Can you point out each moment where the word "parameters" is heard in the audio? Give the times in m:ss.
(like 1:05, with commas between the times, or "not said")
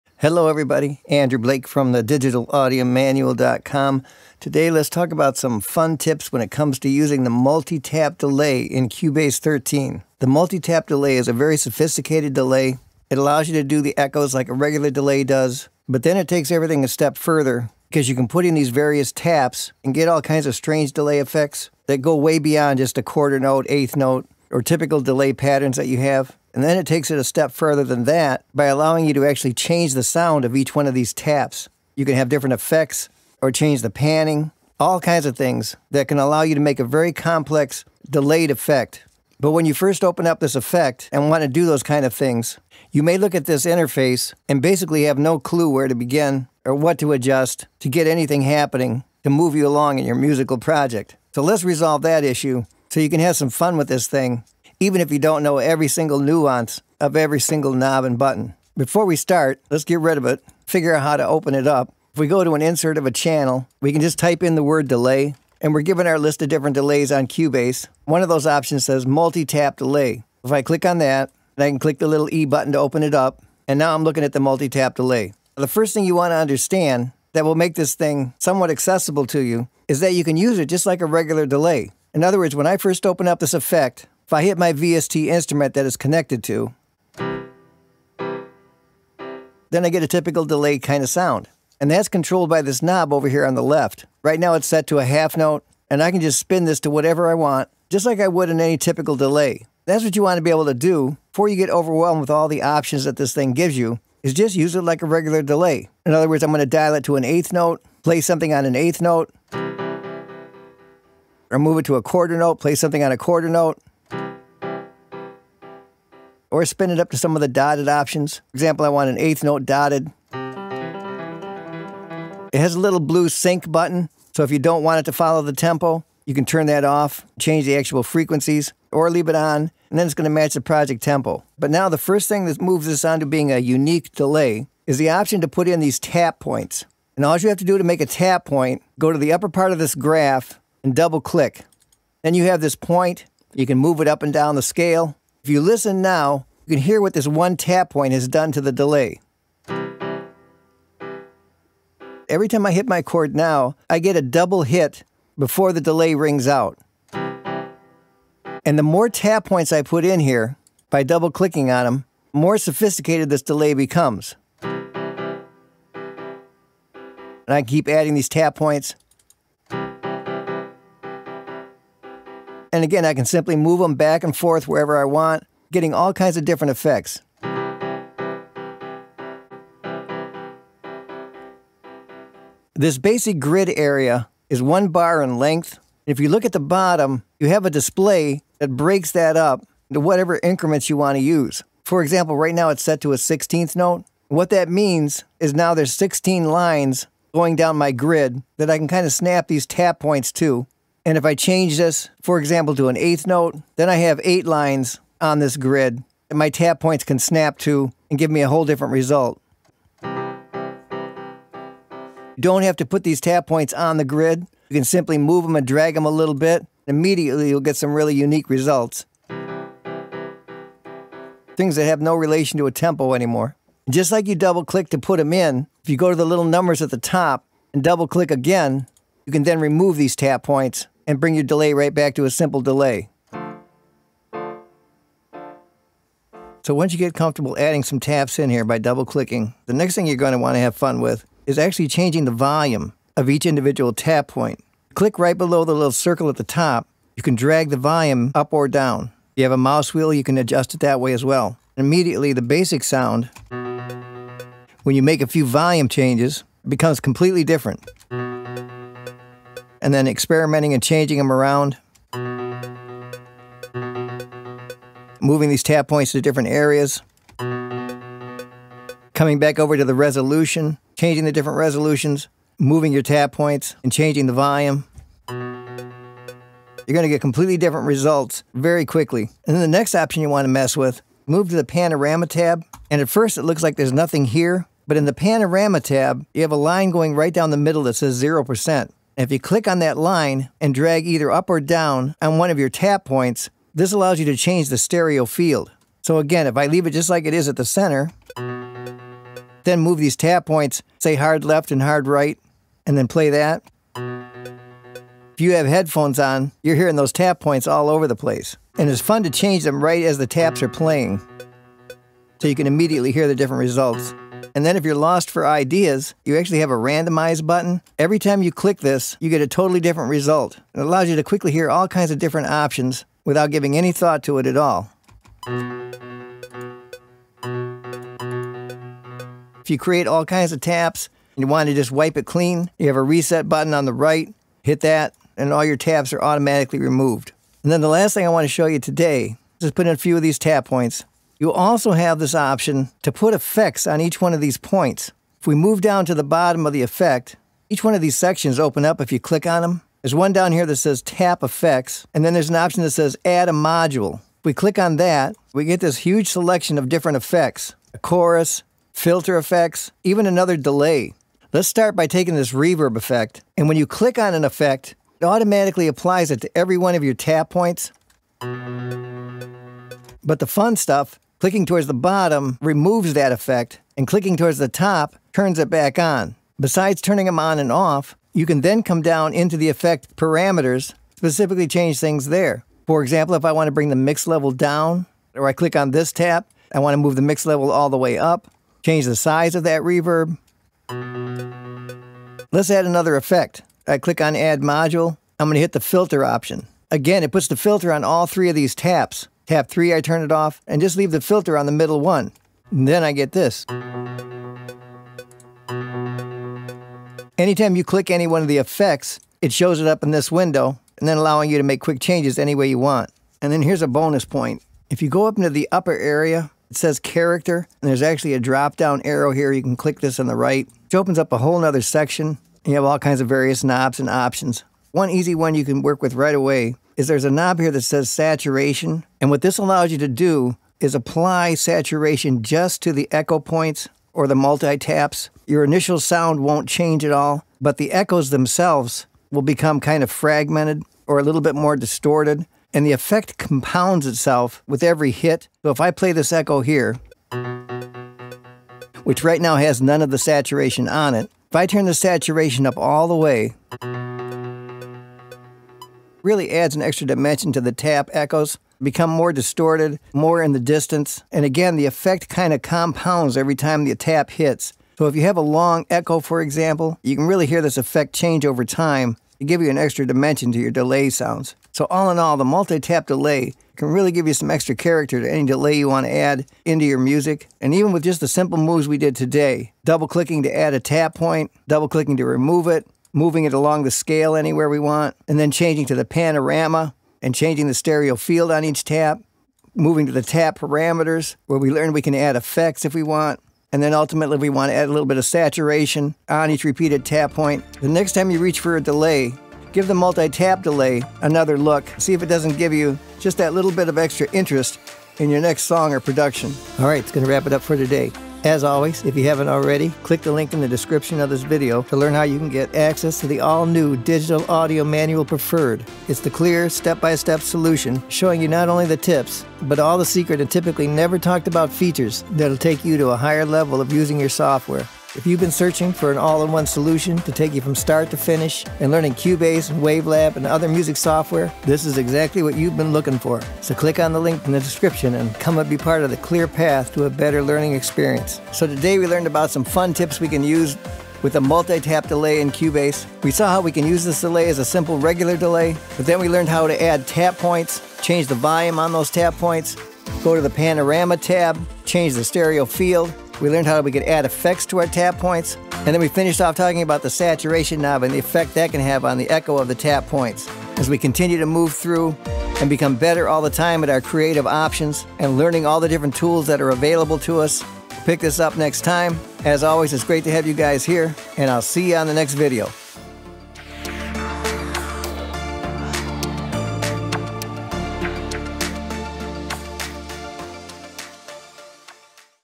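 6:20, 8:10.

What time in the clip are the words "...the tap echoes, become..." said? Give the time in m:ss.
7:37.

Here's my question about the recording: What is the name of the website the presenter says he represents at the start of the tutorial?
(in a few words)
digitalaudiomanual.com.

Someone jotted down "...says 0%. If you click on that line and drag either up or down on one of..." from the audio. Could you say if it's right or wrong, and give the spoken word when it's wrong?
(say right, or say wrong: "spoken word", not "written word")
right.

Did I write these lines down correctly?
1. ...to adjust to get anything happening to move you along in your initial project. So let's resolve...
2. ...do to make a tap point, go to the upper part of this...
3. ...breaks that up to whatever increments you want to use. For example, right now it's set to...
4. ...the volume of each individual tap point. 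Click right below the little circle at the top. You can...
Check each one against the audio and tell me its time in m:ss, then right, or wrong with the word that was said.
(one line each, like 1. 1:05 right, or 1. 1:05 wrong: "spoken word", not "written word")
1. 0:46 wrong: "musical", not "initial"
2. 2:17 right
3. 3:08 right
4. 4:02 right.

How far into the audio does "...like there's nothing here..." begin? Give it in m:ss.
4:43.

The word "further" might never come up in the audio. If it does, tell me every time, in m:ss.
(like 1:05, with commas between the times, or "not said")
0:17, 0:27.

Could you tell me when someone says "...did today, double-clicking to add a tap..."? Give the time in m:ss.
7:58.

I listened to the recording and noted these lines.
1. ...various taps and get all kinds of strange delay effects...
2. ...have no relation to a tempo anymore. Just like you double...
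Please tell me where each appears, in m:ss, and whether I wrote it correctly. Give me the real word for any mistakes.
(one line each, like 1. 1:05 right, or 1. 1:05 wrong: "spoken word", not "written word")
1. 0:18 right
2. 3:41 right.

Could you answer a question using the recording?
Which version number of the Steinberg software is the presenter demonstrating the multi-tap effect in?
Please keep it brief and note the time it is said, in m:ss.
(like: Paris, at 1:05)
13, at 0:08.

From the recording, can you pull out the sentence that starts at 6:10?
But the fun stuff Clicking towards the bottom removes that effect, and clicking towards the top turns it back on.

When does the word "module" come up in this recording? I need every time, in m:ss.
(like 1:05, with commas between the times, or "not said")
5:53, 6:34.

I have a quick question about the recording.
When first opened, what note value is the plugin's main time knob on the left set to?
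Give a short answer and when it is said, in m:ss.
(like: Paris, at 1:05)
half note, at 1:35.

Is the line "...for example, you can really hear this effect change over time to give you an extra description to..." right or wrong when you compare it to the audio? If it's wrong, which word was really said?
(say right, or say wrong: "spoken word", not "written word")
wrong: "dimension", not "description".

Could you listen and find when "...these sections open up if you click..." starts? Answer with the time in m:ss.
5:48.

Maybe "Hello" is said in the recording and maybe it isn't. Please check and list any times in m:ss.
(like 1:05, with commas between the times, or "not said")
0:00.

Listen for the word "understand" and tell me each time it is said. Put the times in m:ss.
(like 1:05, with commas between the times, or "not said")
1:16.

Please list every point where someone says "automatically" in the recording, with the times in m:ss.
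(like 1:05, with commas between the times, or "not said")
5:36, 6:05.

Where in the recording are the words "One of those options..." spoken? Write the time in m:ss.
1:08.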